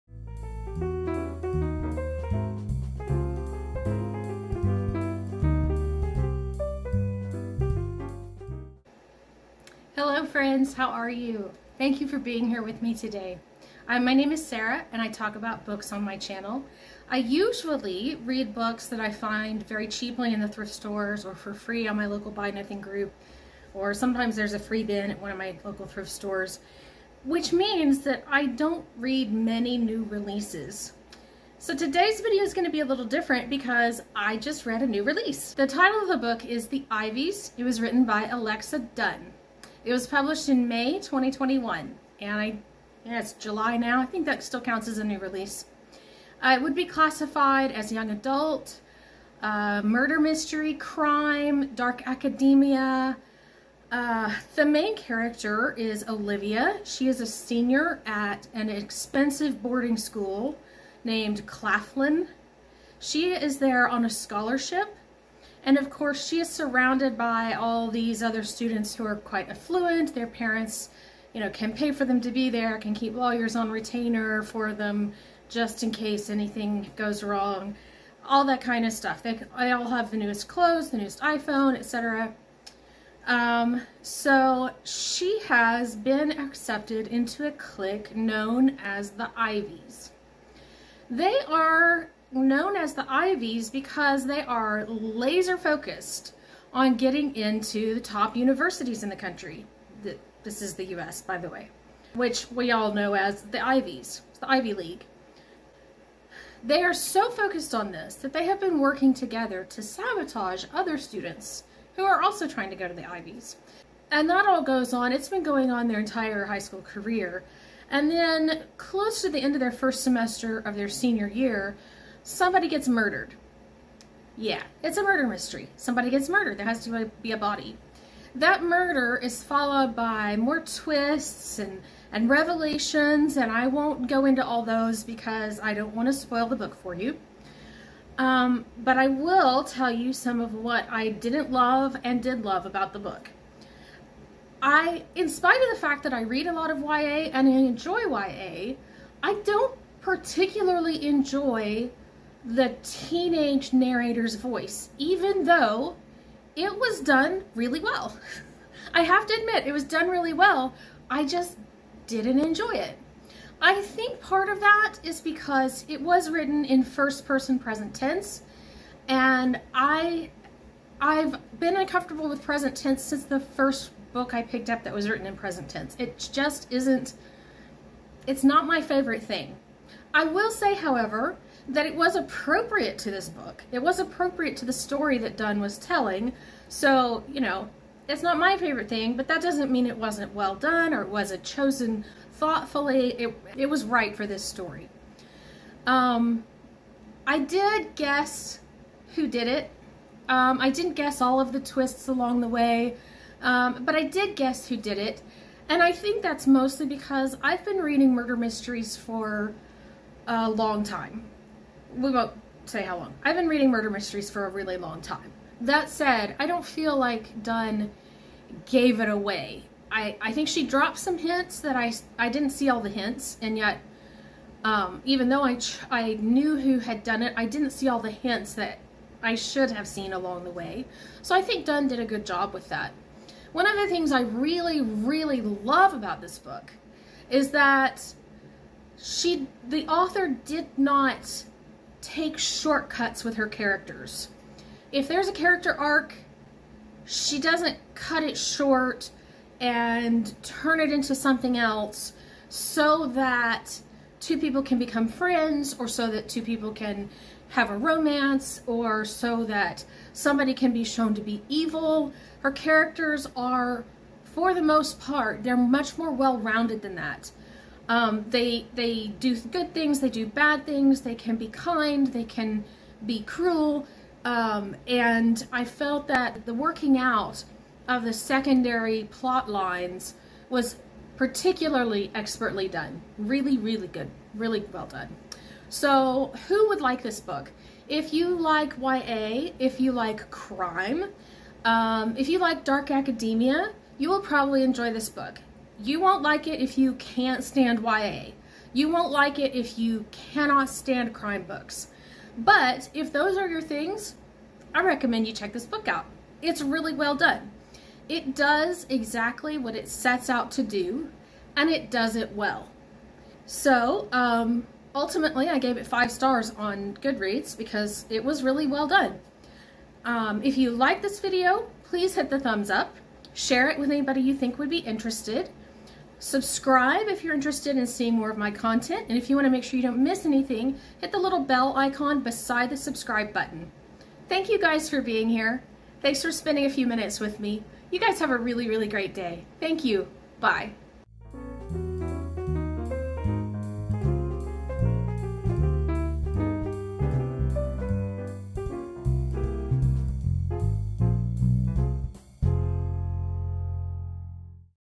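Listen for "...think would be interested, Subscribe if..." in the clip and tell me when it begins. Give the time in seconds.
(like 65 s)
324 s.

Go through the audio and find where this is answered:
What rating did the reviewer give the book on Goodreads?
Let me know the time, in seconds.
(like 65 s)
315 s.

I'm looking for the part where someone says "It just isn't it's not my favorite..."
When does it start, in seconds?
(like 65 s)
175 s.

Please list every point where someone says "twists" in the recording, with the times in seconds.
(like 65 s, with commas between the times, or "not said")
130 s, 201 s.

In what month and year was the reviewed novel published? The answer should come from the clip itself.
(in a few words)
May 2021.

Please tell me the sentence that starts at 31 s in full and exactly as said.
So today's video is going to be a little different because I just read a new release.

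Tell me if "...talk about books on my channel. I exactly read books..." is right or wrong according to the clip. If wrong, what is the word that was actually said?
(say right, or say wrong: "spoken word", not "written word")
wrong: "usually", not "exactly".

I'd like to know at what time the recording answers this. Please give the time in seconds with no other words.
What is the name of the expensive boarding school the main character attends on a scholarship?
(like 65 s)
61 s.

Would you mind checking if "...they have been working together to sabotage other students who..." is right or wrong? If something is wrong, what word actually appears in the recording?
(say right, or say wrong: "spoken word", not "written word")
right.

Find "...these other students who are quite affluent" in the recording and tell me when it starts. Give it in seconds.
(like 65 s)
67 s.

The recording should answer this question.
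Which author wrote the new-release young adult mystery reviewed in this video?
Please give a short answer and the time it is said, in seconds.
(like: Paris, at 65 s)
Alexa Donne, at 38 s.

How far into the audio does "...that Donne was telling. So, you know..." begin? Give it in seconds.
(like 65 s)
185 s.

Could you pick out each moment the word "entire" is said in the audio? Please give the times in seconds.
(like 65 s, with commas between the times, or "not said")
115 s.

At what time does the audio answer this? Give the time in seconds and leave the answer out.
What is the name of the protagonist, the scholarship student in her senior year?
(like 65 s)
56 s.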